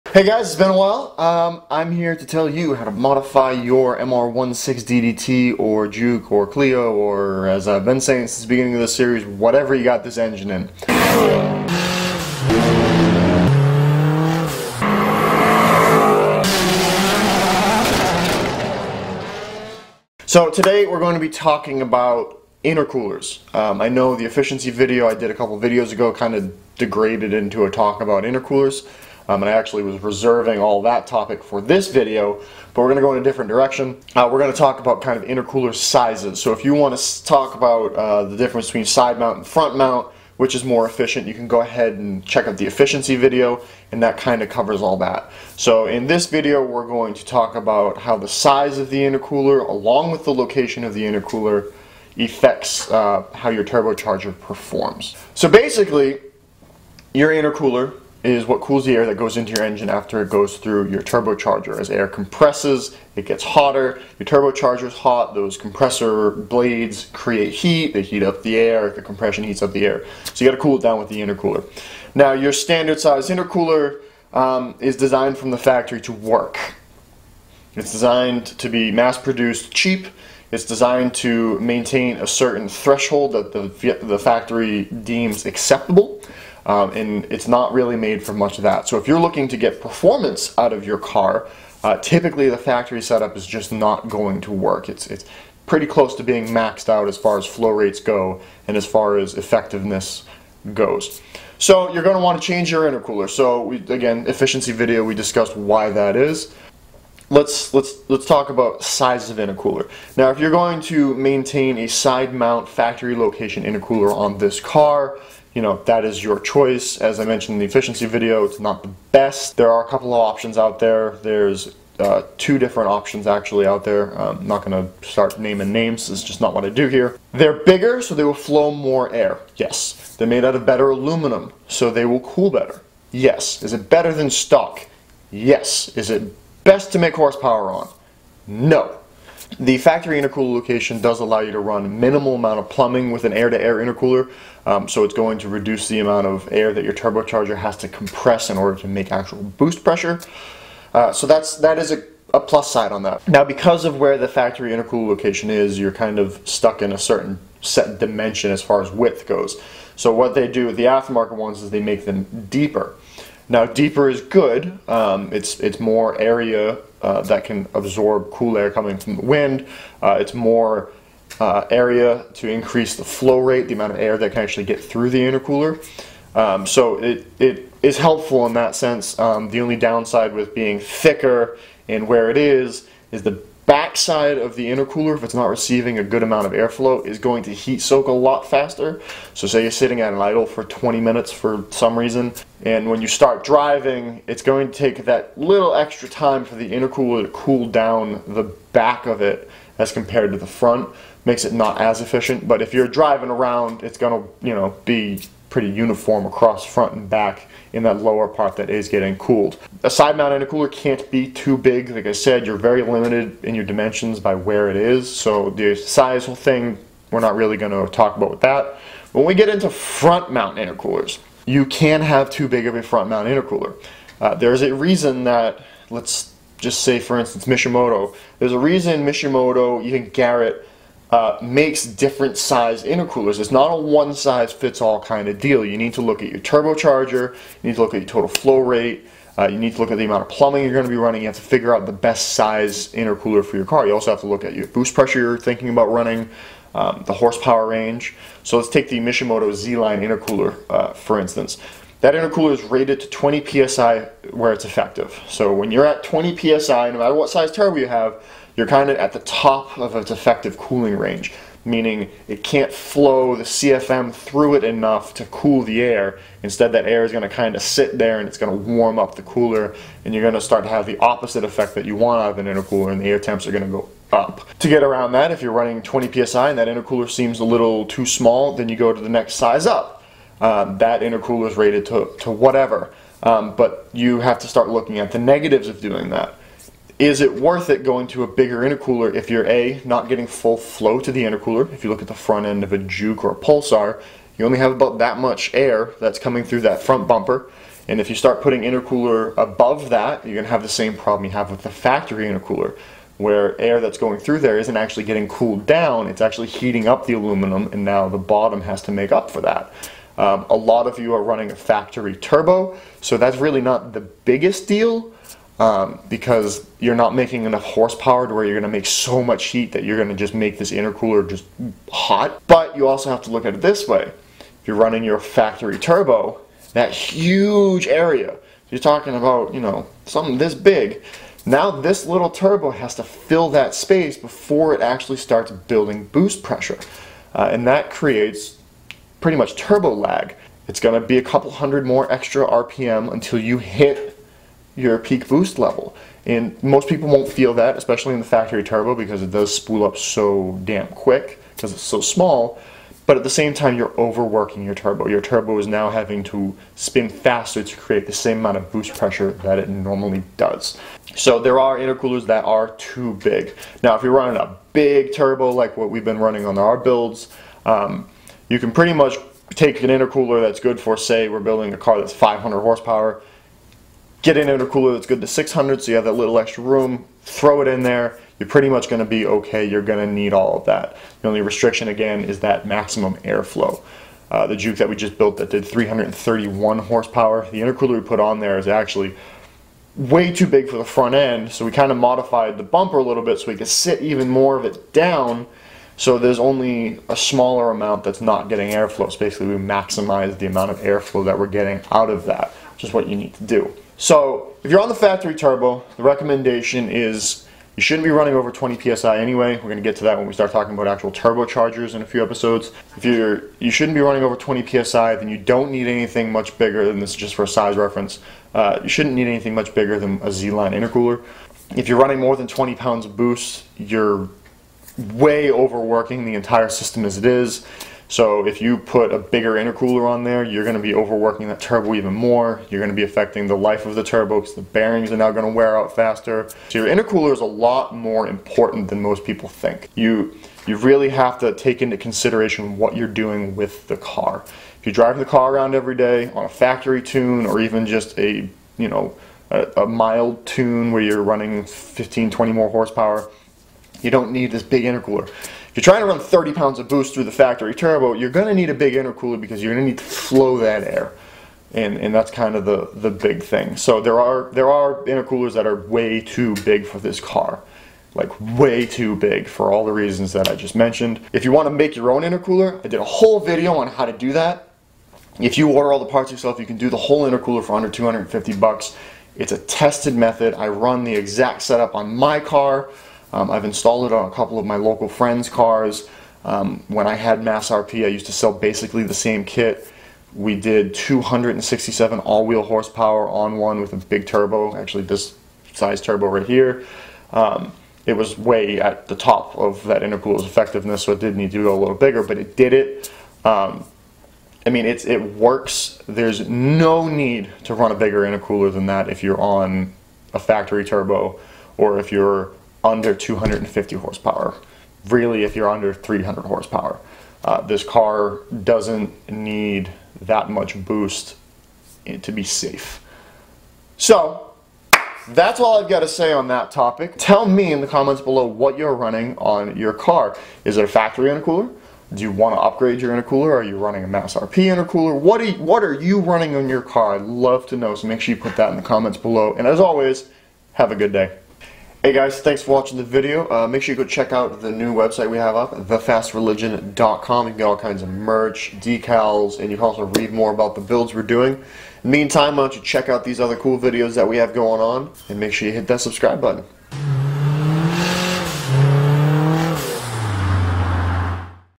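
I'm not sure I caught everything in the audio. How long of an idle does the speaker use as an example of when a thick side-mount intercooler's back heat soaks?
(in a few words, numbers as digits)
20 minutes.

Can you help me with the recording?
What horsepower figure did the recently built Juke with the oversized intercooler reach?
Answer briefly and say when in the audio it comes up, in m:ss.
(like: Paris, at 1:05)
331, at 6:25.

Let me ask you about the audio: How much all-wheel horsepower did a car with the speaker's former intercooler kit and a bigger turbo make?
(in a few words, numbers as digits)
267.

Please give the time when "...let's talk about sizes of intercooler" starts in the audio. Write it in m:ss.
1:48.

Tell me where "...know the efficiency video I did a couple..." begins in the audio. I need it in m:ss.
0:23.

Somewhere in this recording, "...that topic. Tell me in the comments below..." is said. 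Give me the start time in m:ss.
8:46.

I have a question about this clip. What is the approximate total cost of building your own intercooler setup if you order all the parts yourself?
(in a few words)
under 250 bucks.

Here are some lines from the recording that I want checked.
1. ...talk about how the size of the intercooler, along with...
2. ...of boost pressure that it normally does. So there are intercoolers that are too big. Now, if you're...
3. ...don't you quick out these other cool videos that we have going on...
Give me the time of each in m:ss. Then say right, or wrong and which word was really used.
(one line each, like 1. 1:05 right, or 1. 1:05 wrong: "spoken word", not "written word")
1. 0:47 right
2. 5:58 right
3. 9:12 wrong: "check", not "quick".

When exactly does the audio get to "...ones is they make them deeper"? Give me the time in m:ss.
2:41.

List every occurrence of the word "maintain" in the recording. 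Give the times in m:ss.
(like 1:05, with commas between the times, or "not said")
1:21, 1:51.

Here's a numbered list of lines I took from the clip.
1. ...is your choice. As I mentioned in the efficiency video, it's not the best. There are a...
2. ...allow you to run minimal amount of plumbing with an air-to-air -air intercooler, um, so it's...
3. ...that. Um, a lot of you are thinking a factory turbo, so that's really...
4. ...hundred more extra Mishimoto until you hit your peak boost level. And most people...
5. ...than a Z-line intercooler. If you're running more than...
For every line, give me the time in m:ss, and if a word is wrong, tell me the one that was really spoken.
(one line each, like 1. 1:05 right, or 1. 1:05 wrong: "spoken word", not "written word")
1. 1:56 right
2. 2:21 right
3. 5:09 wrong: "running", not "thinking"
4. 5:41 wrong: "RPM", not "Mishimoto"
5. 6:59 right.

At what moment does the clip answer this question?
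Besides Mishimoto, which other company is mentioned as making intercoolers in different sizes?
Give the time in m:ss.
3:50.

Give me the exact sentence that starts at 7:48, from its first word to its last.
Like way too big for all the reasons that I just mentioned.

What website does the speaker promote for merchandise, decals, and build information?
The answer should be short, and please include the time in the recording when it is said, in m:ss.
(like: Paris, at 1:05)
thefastreligion.com, at 9:05.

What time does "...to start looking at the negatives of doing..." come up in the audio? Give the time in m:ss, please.
4:44.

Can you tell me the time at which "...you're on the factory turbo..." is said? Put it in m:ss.
6:44.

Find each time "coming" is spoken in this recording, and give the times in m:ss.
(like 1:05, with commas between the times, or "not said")
2:48, 4:56.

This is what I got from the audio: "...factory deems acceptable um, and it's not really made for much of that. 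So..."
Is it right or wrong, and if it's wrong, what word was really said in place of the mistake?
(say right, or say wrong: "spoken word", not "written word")
right.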